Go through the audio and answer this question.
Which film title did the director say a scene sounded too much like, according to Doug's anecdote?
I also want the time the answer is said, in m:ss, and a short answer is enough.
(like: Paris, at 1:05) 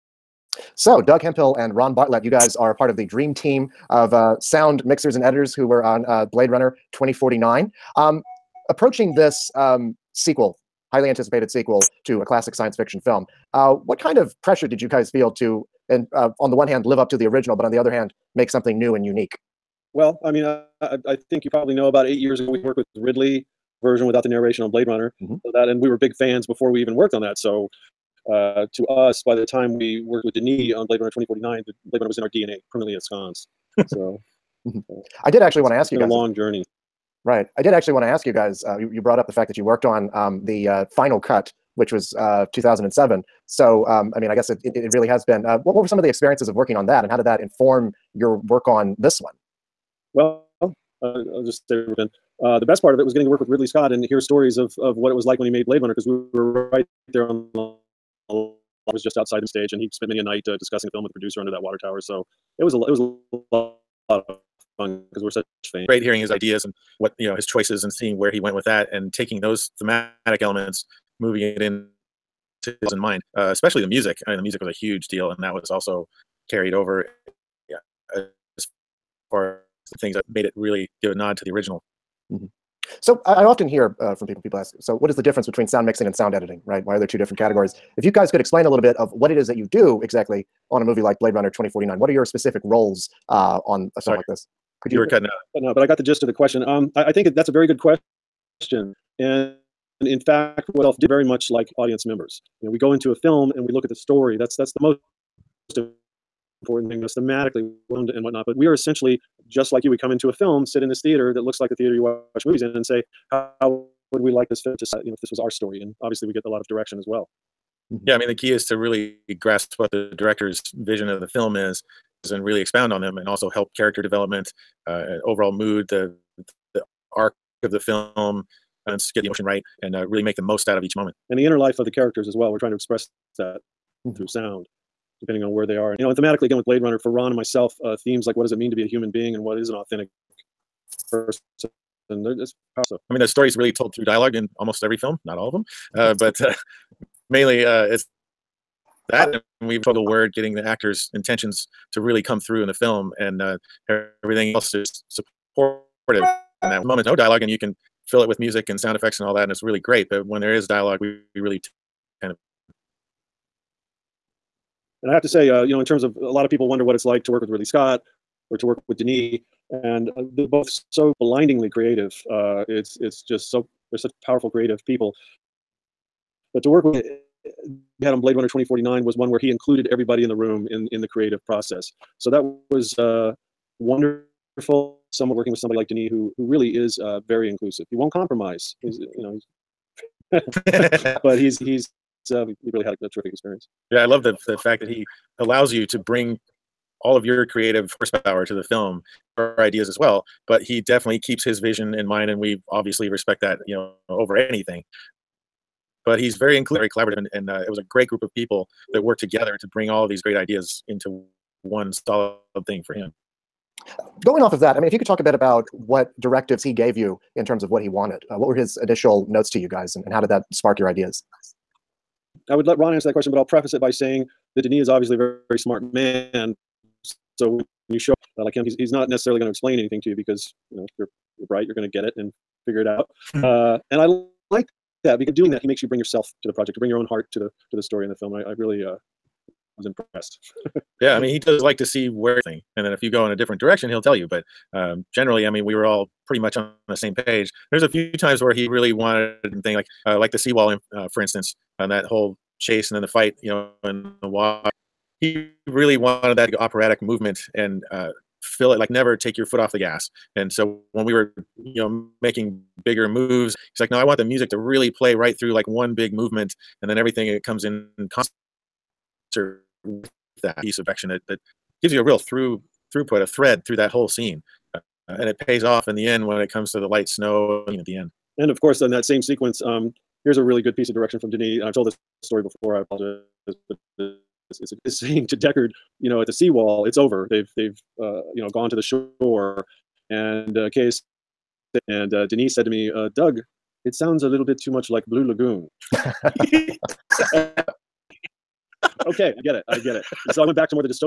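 Blue Lagoon, at 4:55.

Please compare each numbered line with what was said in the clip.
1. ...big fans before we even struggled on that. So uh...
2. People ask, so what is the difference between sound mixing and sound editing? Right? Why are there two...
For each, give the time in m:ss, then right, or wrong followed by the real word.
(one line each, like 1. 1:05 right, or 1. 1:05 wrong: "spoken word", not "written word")
1. 0:25 wrong: "worked", not "struggled"
2. 1:24 right.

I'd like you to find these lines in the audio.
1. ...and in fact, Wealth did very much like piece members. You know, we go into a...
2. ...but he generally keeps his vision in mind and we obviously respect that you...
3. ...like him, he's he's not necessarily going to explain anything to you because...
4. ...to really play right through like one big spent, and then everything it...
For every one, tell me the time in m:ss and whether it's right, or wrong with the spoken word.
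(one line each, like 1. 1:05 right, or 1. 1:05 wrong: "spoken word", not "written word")
1. 1:39 wrong: "audience", not "piece"
2. 3:20 wrong: "definitely", not "generally"
3. 3:48 right
4. 4:24 wrong: "movement", not "spent".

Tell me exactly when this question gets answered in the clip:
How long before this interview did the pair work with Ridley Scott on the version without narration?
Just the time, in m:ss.
0:22.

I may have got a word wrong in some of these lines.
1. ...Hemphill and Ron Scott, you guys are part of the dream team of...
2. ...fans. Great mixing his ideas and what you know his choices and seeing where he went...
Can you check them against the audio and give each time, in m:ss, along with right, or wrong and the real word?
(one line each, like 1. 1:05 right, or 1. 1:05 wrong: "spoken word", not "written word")
1. 0:01 wrong: "Bartlett", not "Scott"
2. 1:05 wrong: "hearing", not "mixing".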